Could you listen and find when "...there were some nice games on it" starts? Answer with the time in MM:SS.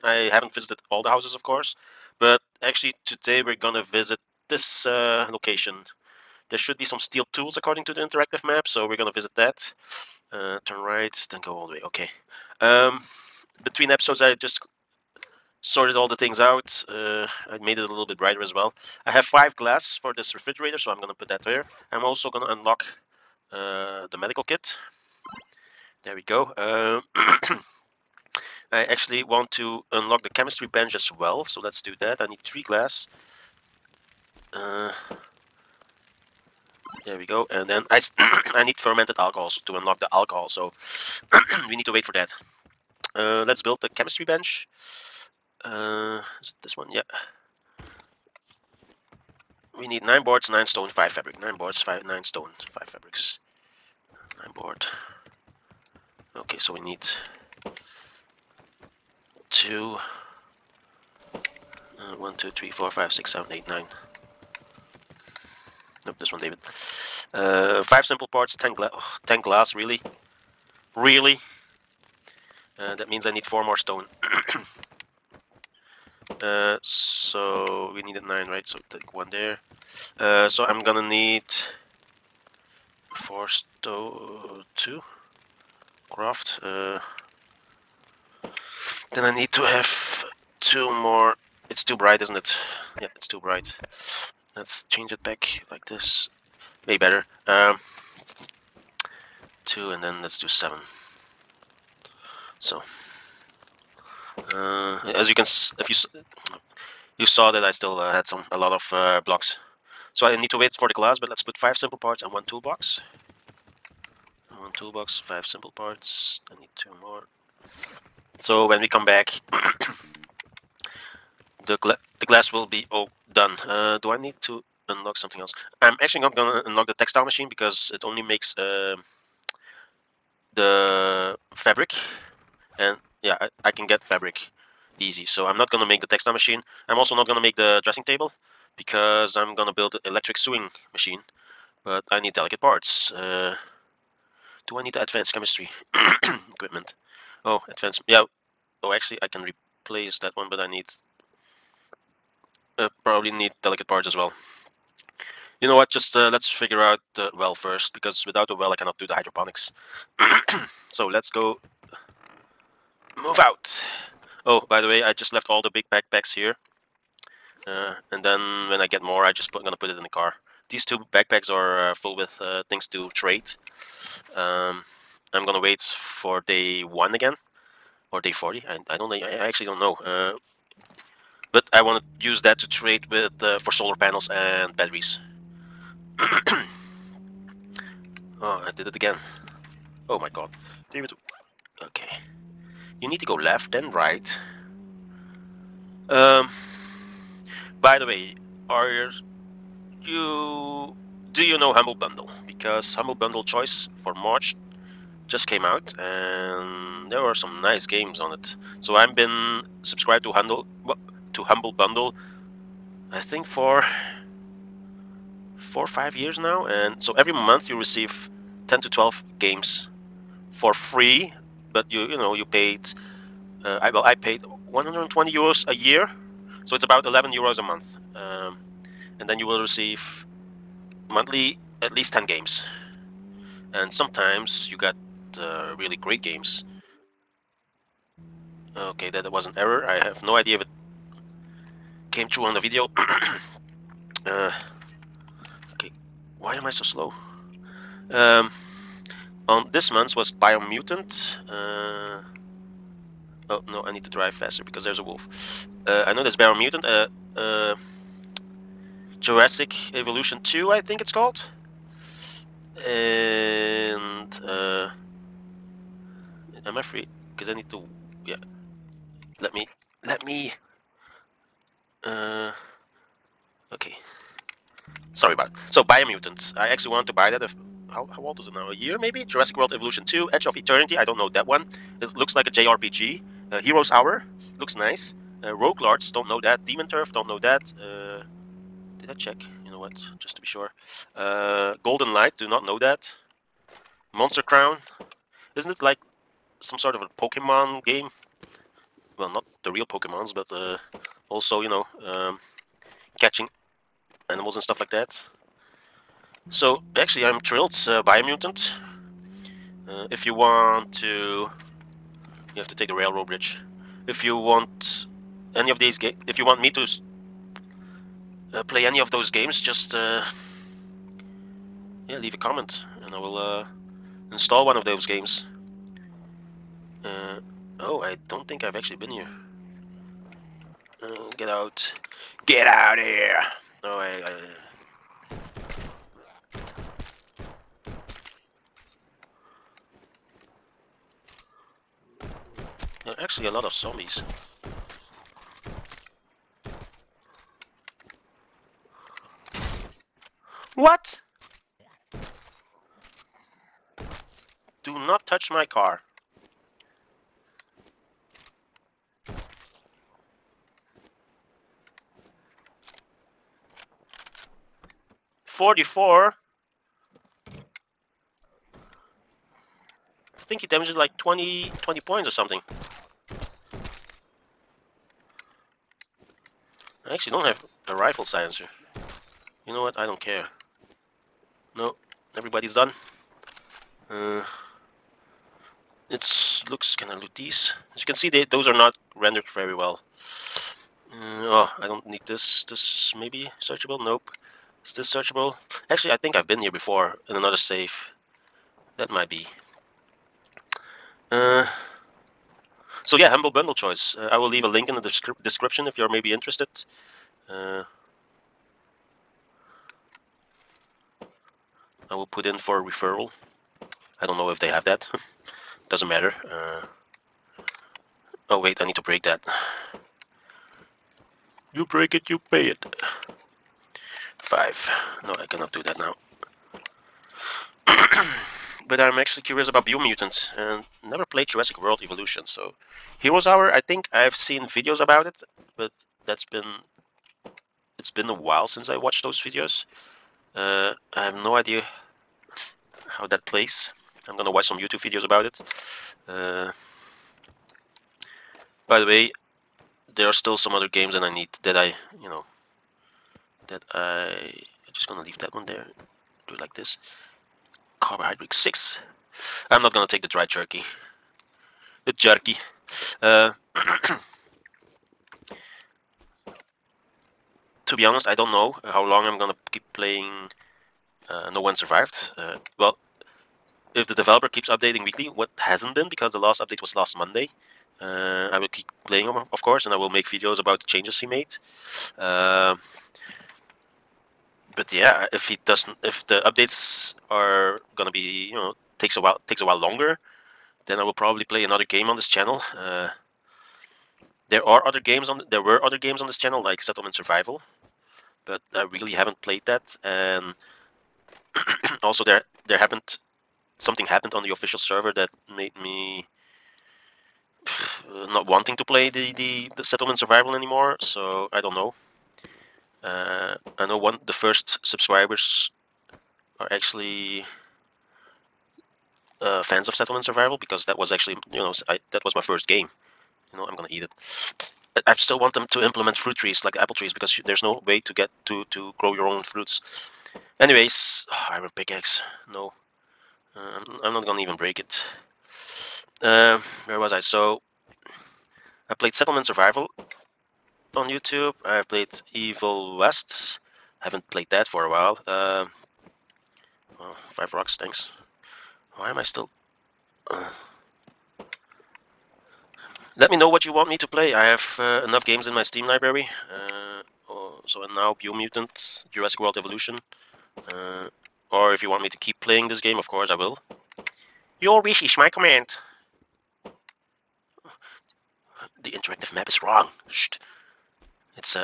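03:27.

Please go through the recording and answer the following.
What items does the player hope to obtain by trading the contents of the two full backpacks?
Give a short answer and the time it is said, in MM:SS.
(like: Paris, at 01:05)
solar panels and batteries, at 03:03.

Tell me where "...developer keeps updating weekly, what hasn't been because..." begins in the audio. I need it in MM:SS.
07:54.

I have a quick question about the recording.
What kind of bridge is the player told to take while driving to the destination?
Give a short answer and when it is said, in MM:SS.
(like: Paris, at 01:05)
railroad bridge, at 05:12.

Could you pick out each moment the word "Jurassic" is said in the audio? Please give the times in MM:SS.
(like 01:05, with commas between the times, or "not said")
04:19, 04:39, 07:11, 09:19.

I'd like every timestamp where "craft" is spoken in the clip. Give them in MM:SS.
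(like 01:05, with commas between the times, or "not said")
01:26.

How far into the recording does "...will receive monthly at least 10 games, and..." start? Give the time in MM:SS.
03:49.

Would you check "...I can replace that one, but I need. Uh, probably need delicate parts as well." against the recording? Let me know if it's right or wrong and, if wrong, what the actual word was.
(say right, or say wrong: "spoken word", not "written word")
right.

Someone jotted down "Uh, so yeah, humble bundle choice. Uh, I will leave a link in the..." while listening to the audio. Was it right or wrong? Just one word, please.
right.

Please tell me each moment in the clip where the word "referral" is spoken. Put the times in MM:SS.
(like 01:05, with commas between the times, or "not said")
06:52.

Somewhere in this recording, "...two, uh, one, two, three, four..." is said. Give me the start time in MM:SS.
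00:59.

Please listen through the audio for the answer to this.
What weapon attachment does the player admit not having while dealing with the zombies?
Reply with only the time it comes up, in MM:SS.
06:17.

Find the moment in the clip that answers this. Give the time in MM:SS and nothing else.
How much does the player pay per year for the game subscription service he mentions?
03:44.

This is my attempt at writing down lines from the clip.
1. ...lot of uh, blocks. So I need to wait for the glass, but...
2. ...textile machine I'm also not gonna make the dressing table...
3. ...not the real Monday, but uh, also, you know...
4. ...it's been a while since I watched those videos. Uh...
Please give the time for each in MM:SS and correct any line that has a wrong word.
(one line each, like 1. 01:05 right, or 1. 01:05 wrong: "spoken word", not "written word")
1. 01:48 right
2. 02:16 right
3. 04:59 wrong: "Pokemons", not "Monday"
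4. 07:17 right.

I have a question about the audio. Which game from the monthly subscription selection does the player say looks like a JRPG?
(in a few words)
Edge of Eternity.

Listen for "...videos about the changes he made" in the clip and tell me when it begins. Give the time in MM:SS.
08:00.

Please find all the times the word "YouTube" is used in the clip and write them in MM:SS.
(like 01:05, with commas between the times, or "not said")
07:24, 09:01.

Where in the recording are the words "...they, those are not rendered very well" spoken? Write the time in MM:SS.
06:28.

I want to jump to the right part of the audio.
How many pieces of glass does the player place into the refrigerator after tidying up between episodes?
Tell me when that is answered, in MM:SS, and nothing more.
00:19.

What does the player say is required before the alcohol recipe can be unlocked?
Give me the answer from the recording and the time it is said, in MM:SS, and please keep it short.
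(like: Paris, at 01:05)
fermented alcohols, at 00:38.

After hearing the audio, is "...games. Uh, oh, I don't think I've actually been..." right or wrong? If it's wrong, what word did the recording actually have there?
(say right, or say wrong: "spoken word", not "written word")
right.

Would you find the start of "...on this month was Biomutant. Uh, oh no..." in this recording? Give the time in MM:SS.
04:09.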